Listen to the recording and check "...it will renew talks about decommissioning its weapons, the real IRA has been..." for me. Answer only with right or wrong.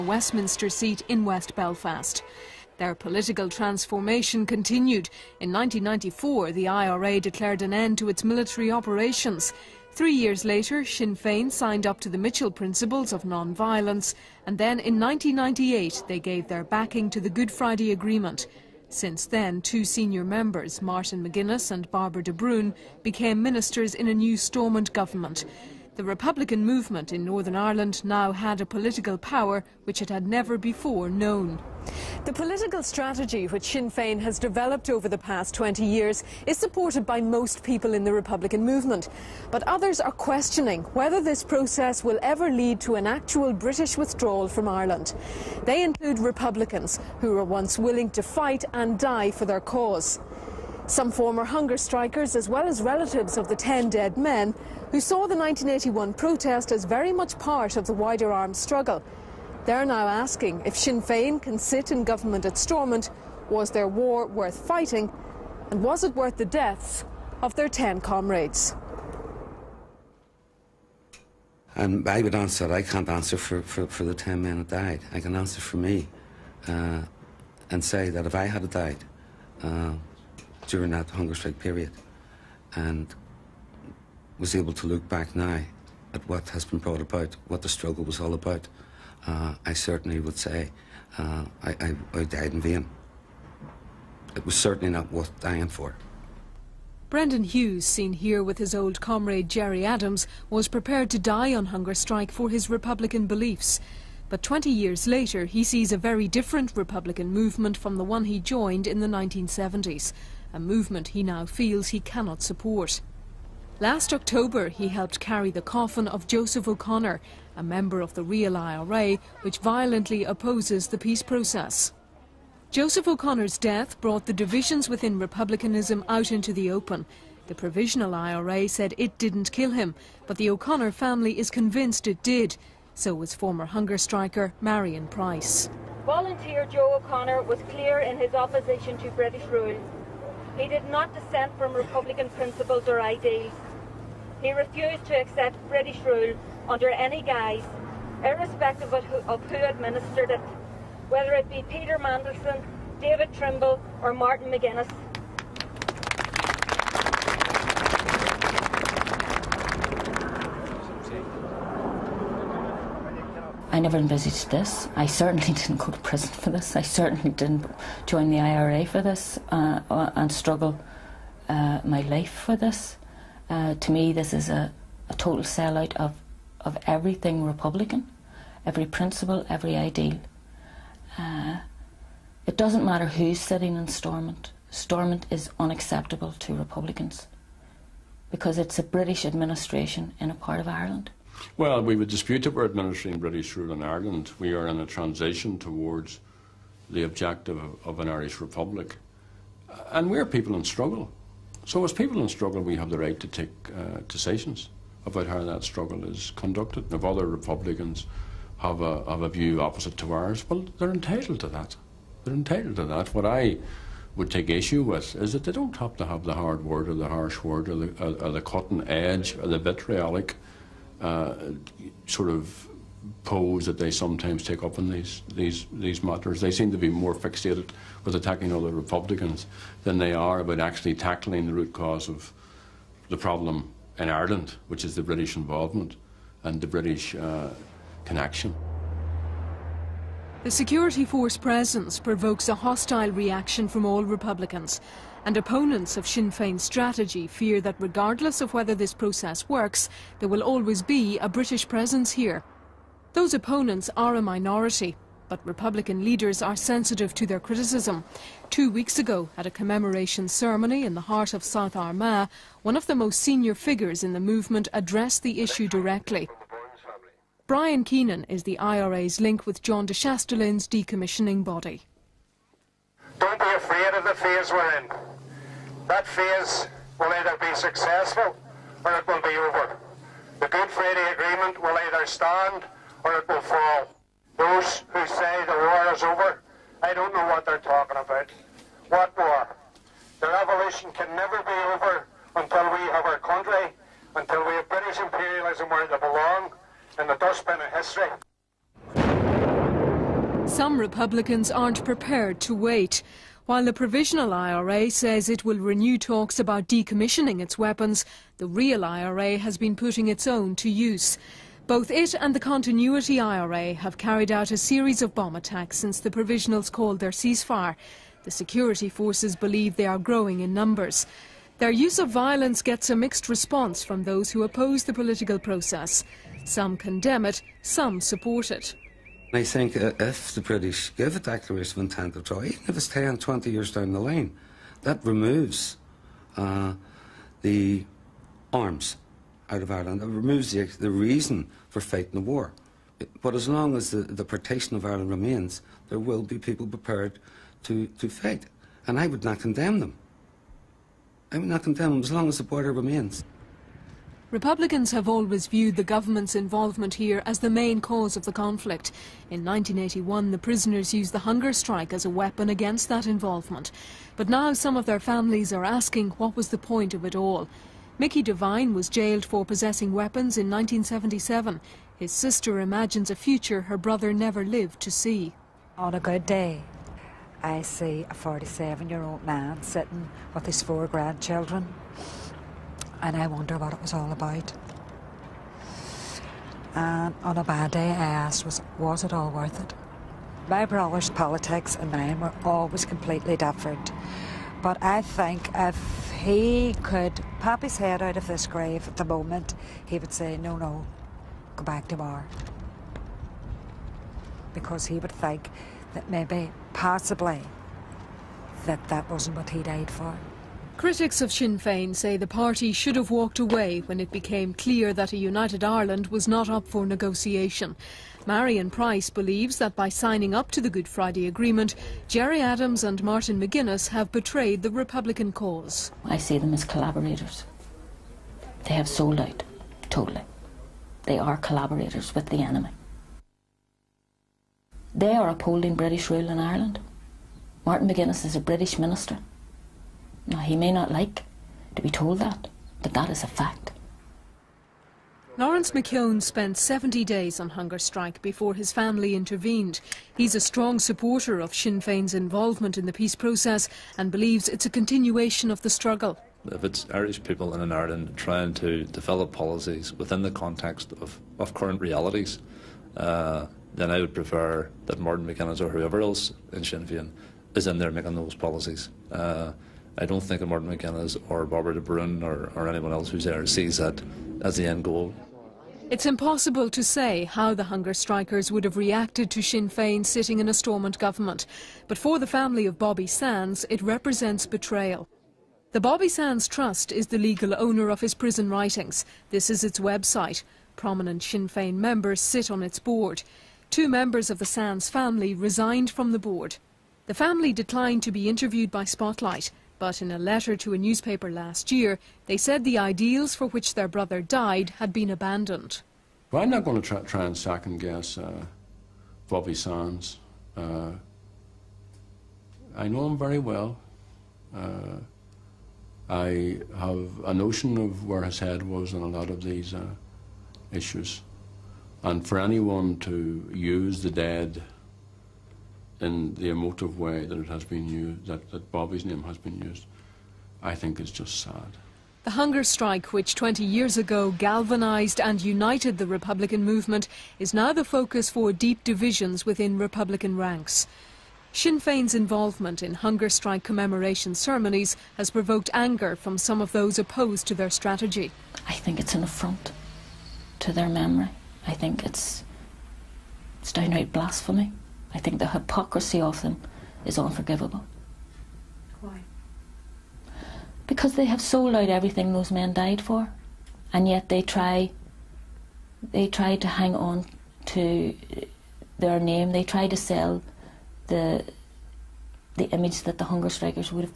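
right.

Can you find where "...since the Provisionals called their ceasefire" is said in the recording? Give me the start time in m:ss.
5:15.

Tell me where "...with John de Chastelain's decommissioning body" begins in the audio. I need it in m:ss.
4:29.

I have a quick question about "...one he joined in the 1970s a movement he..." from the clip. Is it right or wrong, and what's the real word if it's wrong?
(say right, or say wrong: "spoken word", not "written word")
right.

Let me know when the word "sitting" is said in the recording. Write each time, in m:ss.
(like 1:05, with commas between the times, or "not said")
3:03, 6:19, 8:00.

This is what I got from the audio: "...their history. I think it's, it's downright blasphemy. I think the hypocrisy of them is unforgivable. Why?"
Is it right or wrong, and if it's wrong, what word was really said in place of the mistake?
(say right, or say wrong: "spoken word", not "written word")
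wrong: "memory", not "history".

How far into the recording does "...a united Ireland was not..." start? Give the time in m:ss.
6:55.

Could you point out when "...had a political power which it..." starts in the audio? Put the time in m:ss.
0:28.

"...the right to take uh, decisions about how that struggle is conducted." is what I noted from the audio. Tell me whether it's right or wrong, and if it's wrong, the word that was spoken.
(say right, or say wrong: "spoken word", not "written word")
right.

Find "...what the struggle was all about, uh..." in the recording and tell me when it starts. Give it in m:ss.
1:27.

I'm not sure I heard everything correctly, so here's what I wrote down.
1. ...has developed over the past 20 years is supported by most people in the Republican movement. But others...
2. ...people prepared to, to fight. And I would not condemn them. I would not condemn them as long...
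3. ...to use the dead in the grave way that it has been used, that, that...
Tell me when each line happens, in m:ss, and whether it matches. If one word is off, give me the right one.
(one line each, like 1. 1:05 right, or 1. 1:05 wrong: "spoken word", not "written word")
1. 0:34 right
2. 5:46 right
3. 8:42 wrong: "emotive", not "grave".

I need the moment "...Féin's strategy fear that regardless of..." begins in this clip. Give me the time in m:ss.
4:06.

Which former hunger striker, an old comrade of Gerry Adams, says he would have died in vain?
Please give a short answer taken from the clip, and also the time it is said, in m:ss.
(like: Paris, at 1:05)
Brendan Hughes, at 1:37.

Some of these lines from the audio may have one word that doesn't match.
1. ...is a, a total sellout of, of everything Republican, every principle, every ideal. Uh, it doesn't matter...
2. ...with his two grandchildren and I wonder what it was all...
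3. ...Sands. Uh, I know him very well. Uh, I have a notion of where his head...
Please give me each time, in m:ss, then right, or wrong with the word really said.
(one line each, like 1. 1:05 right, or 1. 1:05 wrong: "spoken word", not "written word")
1. 2:54 right
2. 6:20 wrong: "four", not "two"
3. 8:29 right.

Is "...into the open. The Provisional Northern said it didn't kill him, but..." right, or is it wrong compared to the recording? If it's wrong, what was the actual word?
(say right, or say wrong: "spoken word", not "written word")
wrong: "IRA", not "Northern".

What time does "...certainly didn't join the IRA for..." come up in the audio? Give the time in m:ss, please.
2:46.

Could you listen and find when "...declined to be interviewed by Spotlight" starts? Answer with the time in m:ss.
8:17.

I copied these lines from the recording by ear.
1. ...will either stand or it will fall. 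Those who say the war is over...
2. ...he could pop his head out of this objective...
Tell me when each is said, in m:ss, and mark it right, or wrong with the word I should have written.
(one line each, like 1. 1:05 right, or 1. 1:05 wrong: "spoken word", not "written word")
1. 4:41 right
2. 6:36 wrong: "grave", not "objective".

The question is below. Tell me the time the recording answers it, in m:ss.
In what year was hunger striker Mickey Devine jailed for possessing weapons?
6:10.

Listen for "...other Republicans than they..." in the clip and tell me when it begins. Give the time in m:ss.
3:48.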